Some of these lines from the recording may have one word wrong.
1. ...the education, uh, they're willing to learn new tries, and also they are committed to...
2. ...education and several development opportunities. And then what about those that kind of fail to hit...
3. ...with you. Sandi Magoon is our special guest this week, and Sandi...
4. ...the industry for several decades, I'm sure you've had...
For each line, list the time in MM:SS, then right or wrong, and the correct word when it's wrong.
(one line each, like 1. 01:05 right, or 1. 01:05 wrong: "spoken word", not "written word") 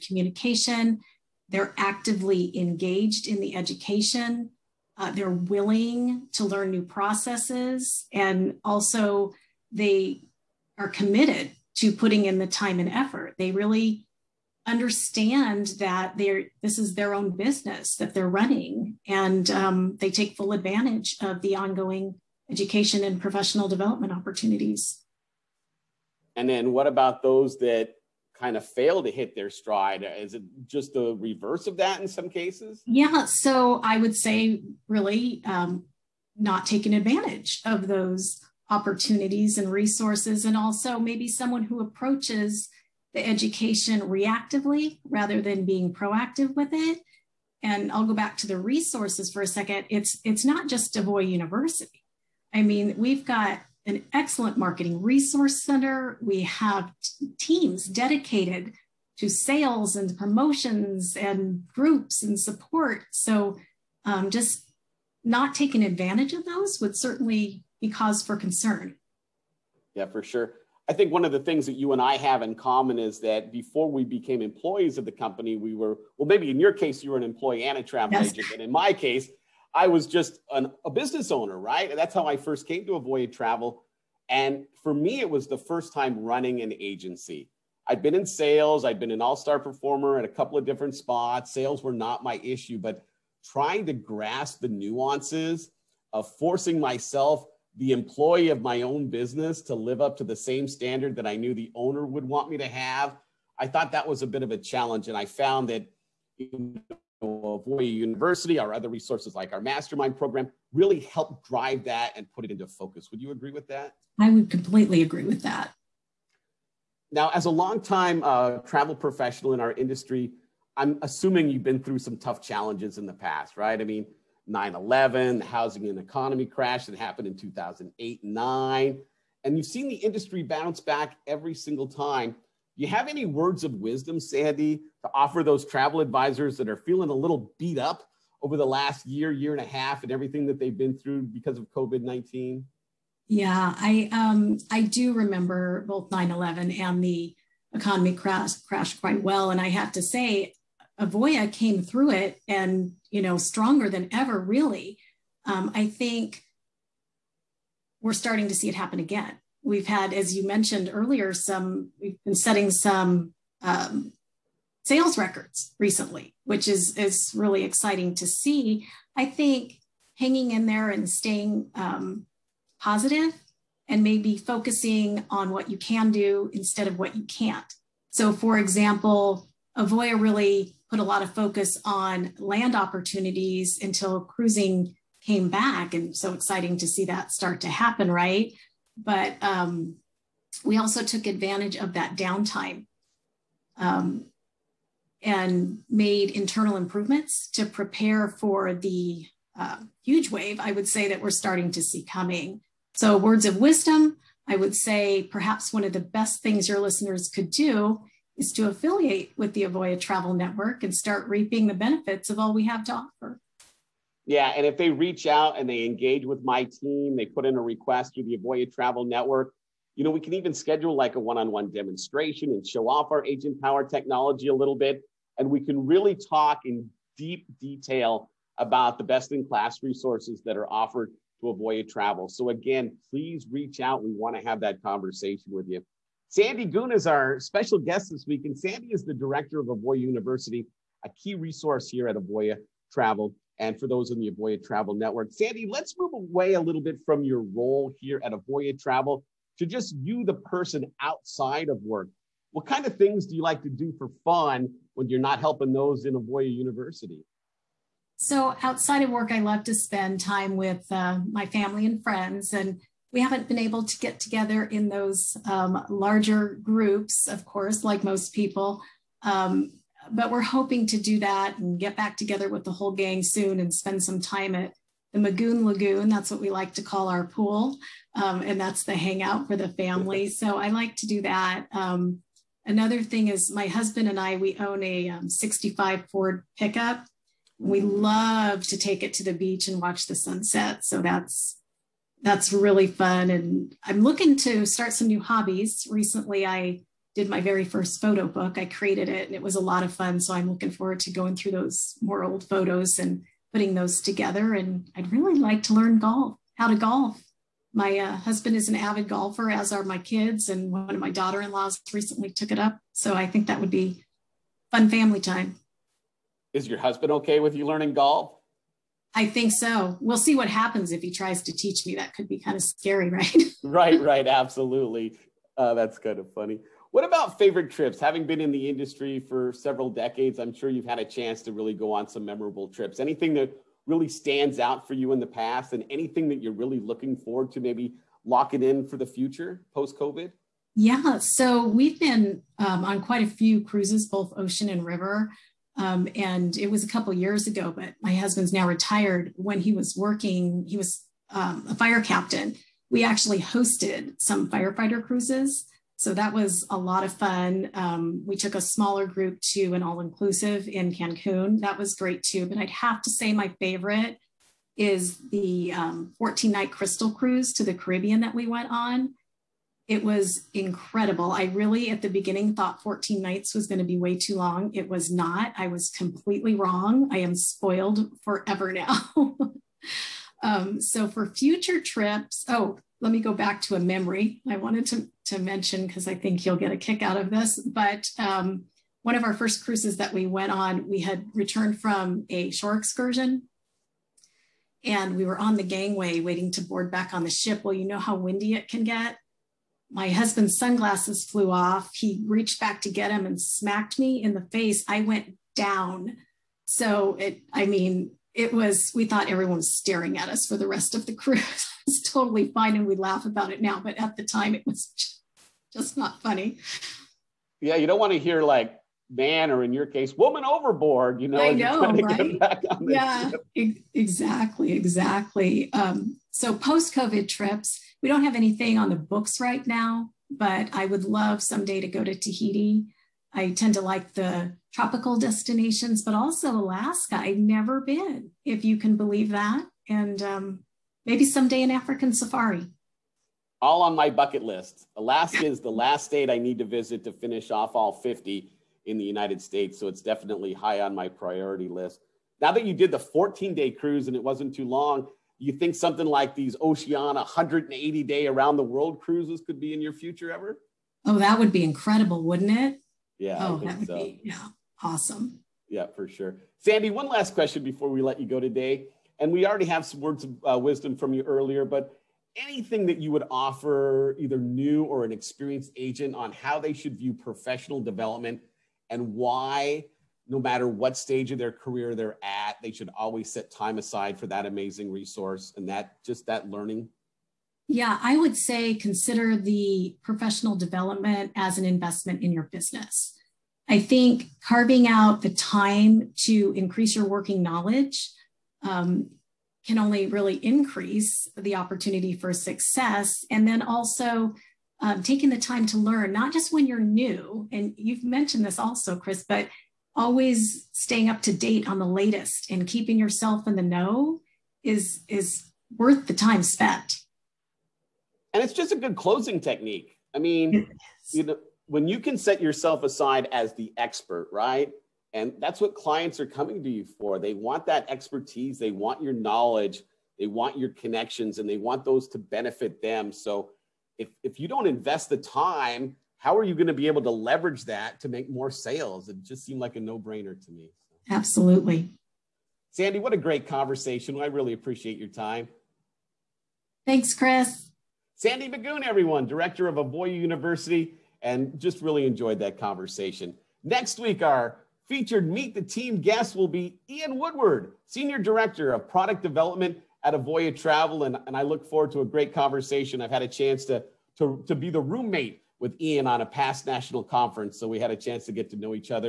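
1. 00:03 wrong: "processes", not "tries"
2. 00:22 wrong: "professional", not "several"
3. 03:55 right
4. 05:28 right.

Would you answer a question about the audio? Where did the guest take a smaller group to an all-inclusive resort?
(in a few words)
Cancun.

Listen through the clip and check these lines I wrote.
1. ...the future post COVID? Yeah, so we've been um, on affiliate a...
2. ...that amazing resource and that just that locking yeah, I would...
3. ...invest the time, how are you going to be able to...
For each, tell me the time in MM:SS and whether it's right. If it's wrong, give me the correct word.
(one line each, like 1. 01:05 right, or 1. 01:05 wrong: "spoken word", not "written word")
1. 05:38 wrong: "quite", not "affiliate"
2. 08:04 wrong: "learning", not "locking"
3. 08:54 right.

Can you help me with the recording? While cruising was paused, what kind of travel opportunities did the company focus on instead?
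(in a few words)
Land opportunities.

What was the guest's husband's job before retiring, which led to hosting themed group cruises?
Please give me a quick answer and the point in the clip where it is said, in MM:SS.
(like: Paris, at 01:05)
Fire captain, at 05:51.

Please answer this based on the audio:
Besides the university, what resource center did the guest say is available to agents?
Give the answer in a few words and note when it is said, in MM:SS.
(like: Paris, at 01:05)
Marketing resource center, at 00:54.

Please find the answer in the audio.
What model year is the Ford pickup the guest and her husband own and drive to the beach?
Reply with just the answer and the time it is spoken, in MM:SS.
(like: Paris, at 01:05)
1965, at 04:45.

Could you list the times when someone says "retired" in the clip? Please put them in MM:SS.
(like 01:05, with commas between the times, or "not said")
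05:48.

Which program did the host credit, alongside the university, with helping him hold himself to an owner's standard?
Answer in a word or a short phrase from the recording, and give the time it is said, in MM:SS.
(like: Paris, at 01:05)
Mastermind program, at 01:49.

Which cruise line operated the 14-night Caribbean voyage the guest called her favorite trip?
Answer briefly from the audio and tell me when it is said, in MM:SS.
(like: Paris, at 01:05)
Crystal, at 06:06.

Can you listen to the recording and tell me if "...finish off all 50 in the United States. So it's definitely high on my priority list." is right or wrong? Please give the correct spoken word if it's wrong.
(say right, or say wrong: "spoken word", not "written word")
right.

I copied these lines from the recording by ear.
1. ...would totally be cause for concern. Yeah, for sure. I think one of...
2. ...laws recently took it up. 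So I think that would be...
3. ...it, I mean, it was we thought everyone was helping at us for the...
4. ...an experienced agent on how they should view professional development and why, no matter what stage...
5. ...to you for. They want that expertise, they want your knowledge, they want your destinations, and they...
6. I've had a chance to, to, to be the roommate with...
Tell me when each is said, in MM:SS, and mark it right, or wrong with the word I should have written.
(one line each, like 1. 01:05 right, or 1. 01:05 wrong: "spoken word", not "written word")
1. 01:06 wrong: "certainly", not "totally"
2. 05:11 right
3. 06:47 wrong: "staring", not "helping"
4. 07:55 right
5. 08:46 wrong: "connections", not "destinations"
6. 09:23 right.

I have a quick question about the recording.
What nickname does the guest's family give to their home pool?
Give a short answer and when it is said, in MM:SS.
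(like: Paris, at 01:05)
Magoon Lagoon, at 04:35.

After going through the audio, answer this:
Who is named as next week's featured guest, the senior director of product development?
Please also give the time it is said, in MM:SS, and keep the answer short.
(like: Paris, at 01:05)
Ian Woodward, at 09:16.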